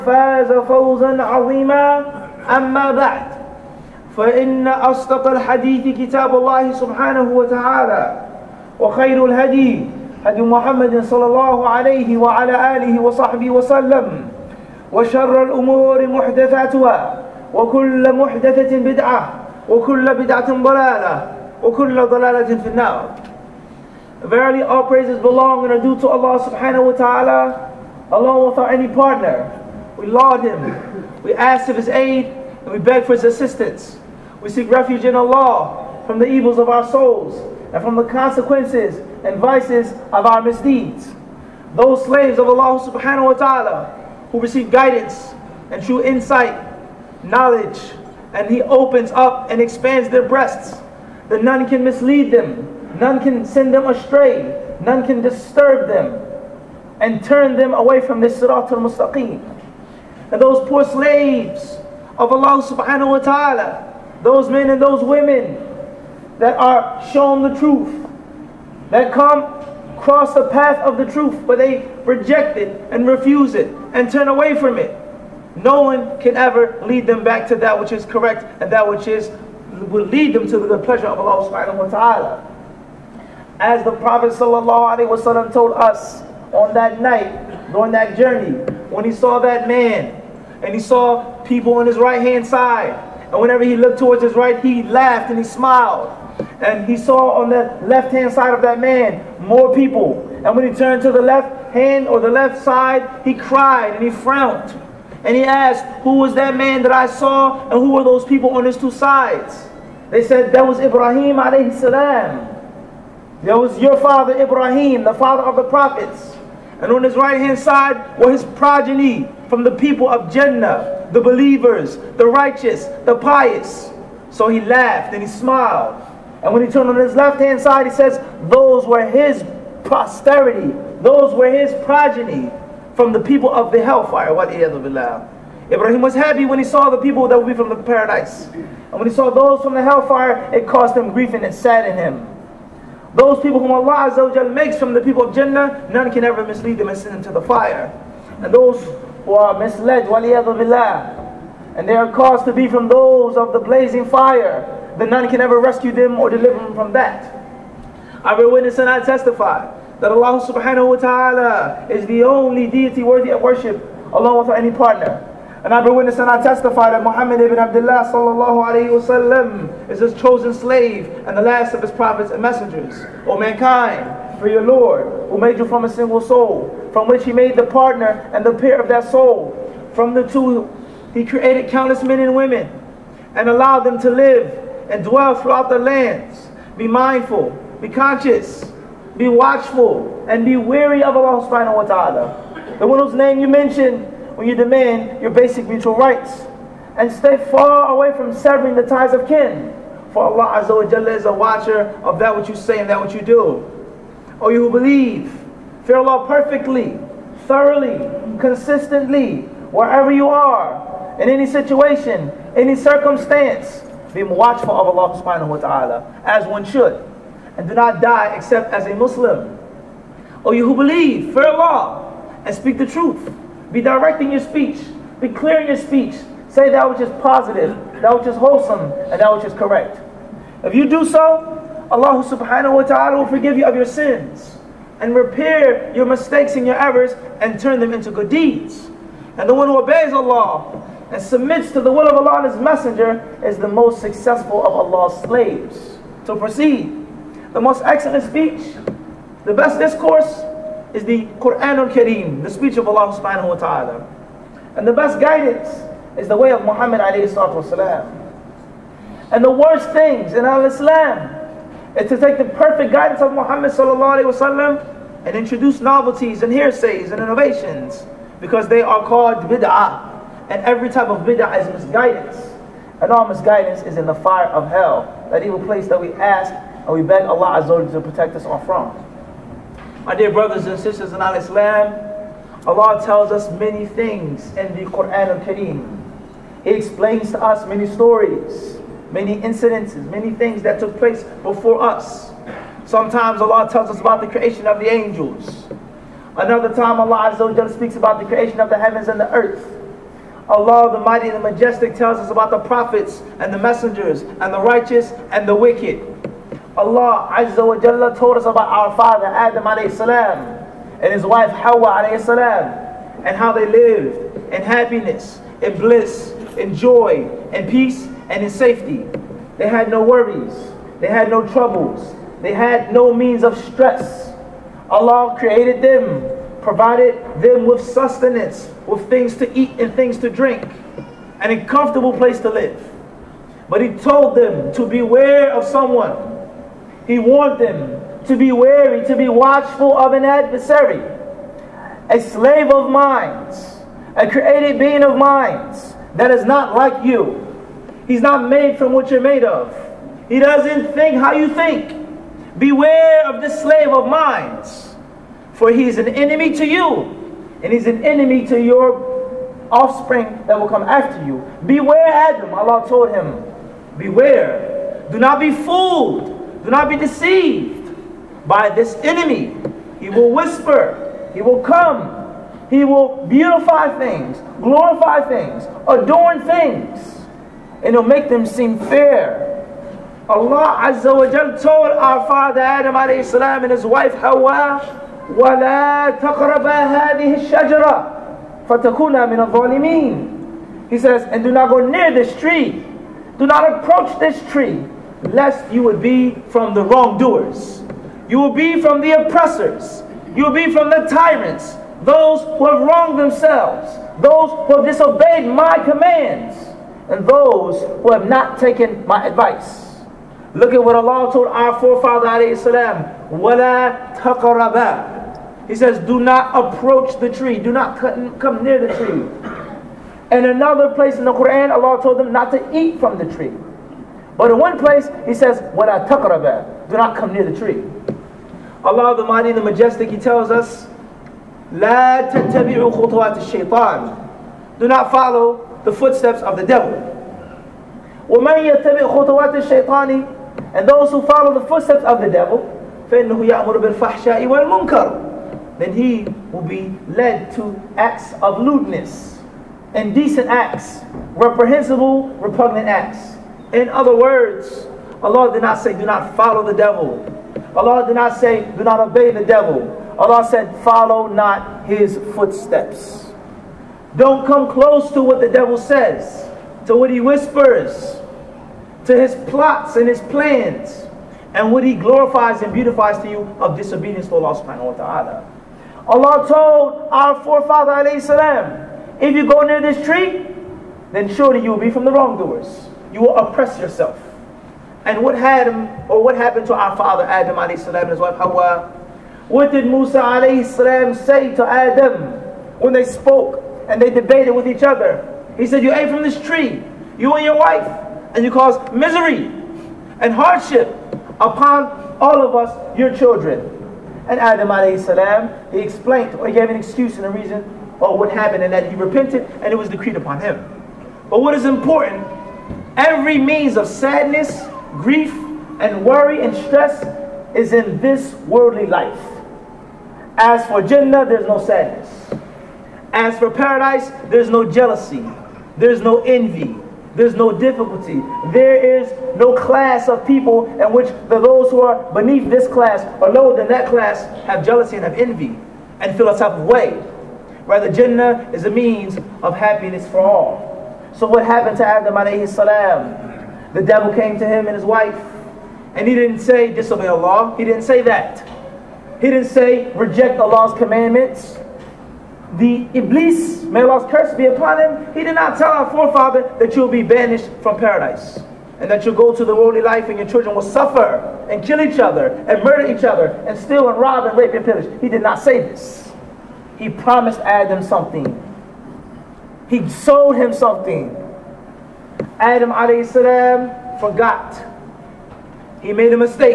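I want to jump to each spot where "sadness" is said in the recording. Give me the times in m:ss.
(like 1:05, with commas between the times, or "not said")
8:33, 8:41.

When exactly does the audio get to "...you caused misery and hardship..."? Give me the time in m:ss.
8:18.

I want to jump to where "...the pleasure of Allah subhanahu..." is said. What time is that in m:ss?
1:20.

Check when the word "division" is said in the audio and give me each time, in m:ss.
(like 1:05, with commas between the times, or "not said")
not said.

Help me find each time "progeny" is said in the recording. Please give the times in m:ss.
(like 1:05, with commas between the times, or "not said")
1:58, 2:11.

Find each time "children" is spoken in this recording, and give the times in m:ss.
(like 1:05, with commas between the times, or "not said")
8:23, 9:20.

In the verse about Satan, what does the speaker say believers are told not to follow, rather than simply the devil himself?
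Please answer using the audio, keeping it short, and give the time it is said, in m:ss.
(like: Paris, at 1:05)
His footsteps, at 7:40.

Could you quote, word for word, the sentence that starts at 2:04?
So he laughed and he smiled.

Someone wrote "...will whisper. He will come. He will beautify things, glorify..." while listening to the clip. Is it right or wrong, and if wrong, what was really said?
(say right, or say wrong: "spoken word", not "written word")
right.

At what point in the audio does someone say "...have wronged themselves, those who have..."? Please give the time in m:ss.
6:42.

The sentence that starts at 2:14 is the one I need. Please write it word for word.
What Ibrahim was happy when he saw the people that would be from the paradise.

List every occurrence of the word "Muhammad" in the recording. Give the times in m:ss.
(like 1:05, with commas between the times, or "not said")
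2:47, 4:16, 4:23.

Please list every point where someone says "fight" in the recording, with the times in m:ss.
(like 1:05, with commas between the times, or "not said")
not said.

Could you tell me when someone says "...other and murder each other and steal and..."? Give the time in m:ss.
9:21.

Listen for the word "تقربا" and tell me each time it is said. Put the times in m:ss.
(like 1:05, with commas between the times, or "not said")
6:26, 6:54, 7:06.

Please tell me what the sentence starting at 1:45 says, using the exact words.
And he asked, who was that man that I saw and who were those people on his two sides?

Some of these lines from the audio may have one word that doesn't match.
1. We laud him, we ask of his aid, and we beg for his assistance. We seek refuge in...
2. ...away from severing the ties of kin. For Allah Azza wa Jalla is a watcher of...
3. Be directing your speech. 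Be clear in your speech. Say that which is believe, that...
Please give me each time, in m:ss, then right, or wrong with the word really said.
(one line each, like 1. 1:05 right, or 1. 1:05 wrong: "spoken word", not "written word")
1. 0:29 right
2. 3:17 right
3. 3:43 wrong: "positive", not "believe".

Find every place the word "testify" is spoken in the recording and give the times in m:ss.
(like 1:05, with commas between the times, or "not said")
2:39, 2:46.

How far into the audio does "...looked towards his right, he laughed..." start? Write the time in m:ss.
1:33.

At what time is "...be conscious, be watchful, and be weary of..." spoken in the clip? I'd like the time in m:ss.
3:07.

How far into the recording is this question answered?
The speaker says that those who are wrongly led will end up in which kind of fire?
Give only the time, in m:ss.
2:33.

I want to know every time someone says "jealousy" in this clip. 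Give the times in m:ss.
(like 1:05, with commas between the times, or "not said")
8:44, 8:54.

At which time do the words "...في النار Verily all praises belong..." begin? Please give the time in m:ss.
0:22.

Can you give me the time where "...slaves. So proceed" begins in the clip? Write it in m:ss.
4:05.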